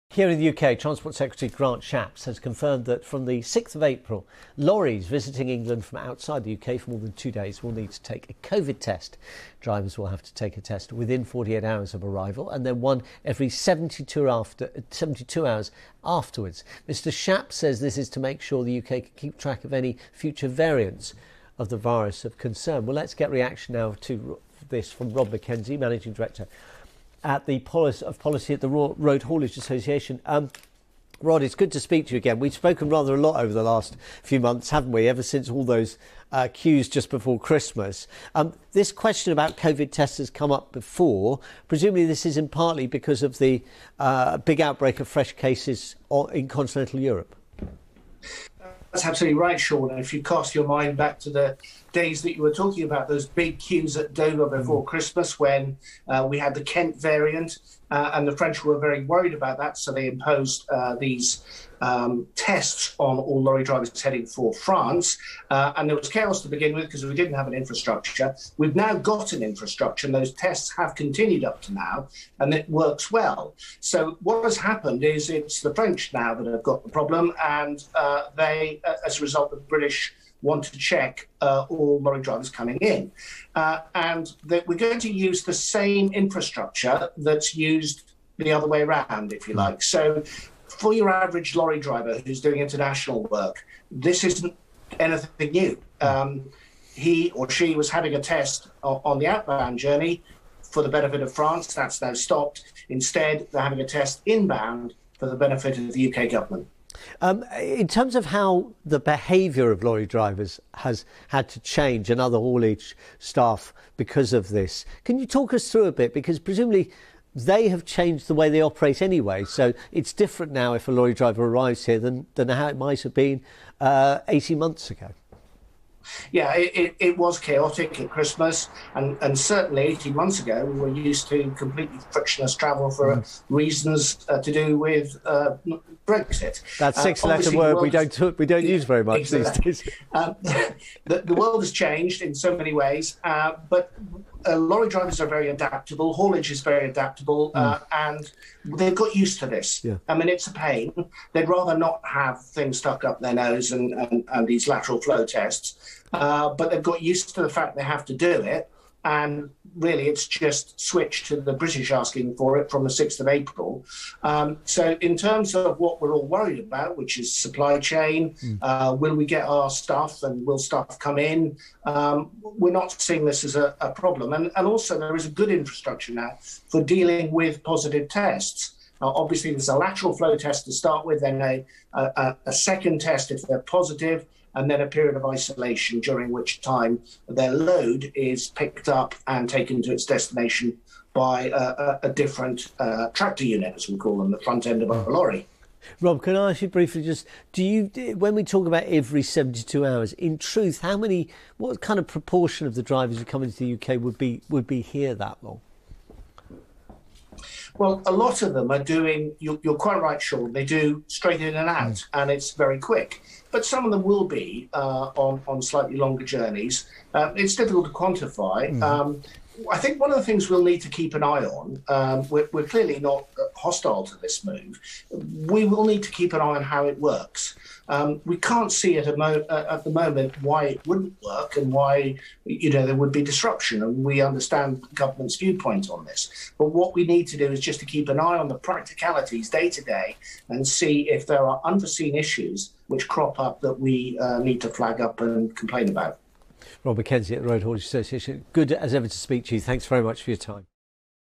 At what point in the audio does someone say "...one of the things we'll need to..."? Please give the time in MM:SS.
03:39.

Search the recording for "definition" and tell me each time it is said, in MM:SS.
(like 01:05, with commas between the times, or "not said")
not said.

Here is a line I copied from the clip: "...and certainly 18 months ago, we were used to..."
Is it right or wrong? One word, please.
right.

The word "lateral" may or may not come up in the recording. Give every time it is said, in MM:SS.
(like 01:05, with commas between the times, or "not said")
02:34, 02:59.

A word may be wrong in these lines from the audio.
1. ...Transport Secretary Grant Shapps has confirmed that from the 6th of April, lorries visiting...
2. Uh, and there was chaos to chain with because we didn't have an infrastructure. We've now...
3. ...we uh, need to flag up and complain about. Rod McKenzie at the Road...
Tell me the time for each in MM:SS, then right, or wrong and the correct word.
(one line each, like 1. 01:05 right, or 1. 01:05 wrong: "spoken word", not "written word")
1. 00:00 right
2. 01:05 wrong: "begin", not "chain"
3. 04:03 right.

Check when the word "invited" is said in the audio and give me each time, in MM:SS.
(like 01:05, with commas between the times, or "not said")
not said.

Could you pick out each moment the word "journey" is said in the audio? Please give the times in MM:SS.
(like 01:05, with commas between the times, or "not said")
01:39, 03:36.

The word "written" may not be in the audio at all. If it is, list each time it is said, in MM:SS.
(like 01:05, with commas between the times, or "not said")
not said.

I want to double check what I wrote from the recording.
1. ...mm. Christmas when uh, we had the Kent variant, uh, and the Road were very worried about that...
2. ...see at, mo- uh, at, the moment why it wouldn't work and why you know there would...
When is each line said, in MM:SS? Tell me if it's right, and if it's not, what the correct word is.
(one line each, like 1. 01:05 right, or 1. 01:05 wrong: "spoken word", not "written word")
1. 00:54 wrong: "French", not "Road"
2. 03:48 right.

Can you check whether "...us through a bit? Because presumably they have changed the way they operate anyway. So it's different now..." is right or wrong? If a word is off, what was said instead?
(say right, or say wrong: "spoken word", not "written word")
right.